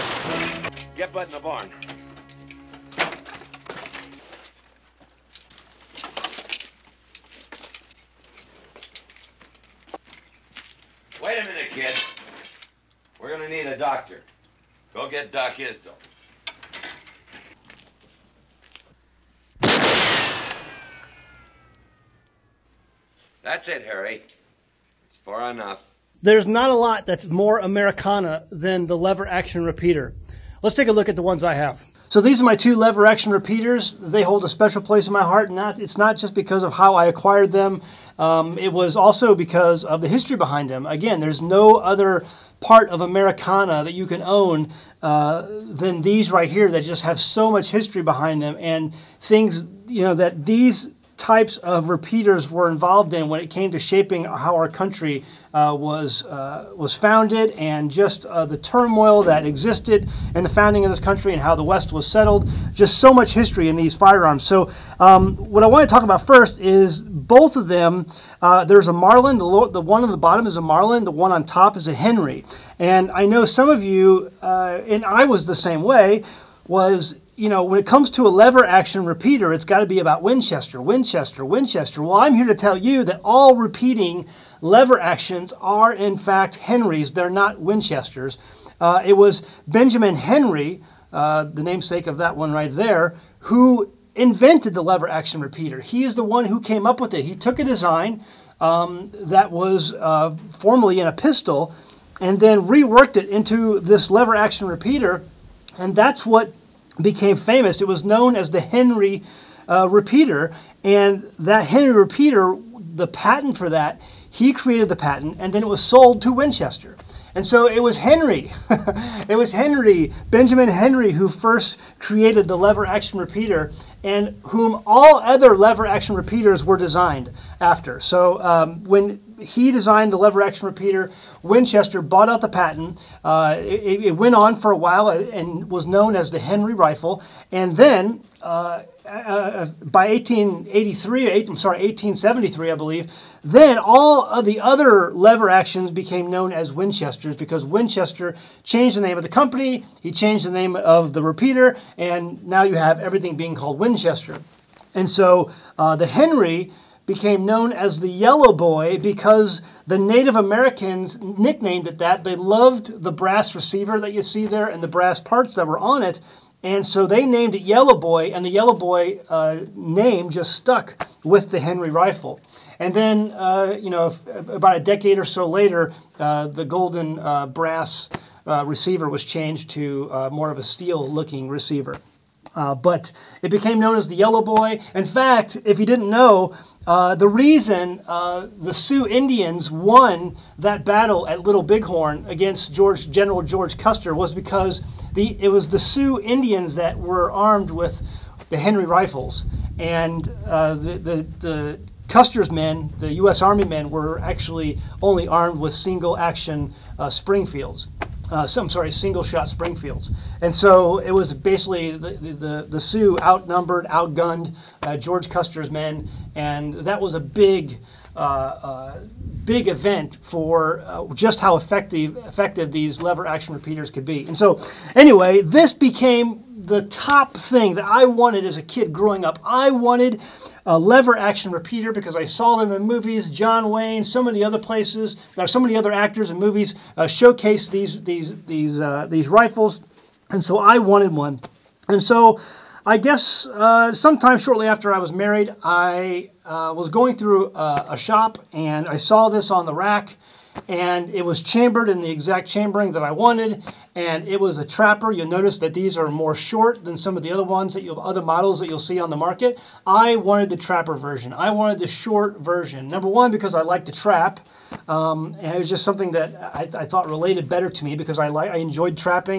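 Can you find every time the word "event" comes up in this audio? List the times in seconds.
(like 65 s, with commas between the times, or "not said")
219 s.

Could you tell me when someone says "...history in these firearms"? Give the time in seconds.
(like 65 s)
63 s.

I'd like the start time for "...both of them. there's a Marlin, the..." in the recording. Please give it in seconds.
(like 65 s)
67 s.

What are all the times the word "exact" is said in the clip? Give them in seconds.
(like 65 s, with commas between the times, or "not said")
252 s.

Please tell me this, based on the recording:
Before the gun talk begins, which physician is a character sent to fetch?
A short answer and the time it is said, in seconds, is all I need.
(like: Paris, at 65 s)
Doc Isdell, at 15 s.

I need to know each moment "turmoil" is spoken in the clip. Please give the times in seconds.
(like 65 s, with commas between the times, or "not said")
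58 s.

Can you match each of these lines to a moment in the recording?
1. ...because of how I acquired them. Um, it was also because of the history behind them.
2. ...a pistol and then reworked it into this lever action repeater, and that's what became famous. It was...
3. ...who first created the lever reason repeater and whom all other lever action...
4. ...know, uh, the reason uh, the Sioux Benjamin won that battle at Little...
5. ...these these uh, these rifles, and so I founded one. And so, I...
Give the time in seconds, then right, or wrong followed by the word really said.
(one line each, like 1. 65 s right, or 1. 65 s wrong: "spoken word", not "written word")
1. 36 s right
2. 101 s right
3. 121 s wrong: "action", not "reason"
4. 186 s wrong: "Indians", not "Benjamin"
5. 238 s wrong: "wanted", not "founded".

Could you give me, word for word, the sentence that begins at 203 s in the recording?
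Army men, were actually only armed with single action uh, Springfields uh, some sorry single shot Springfields.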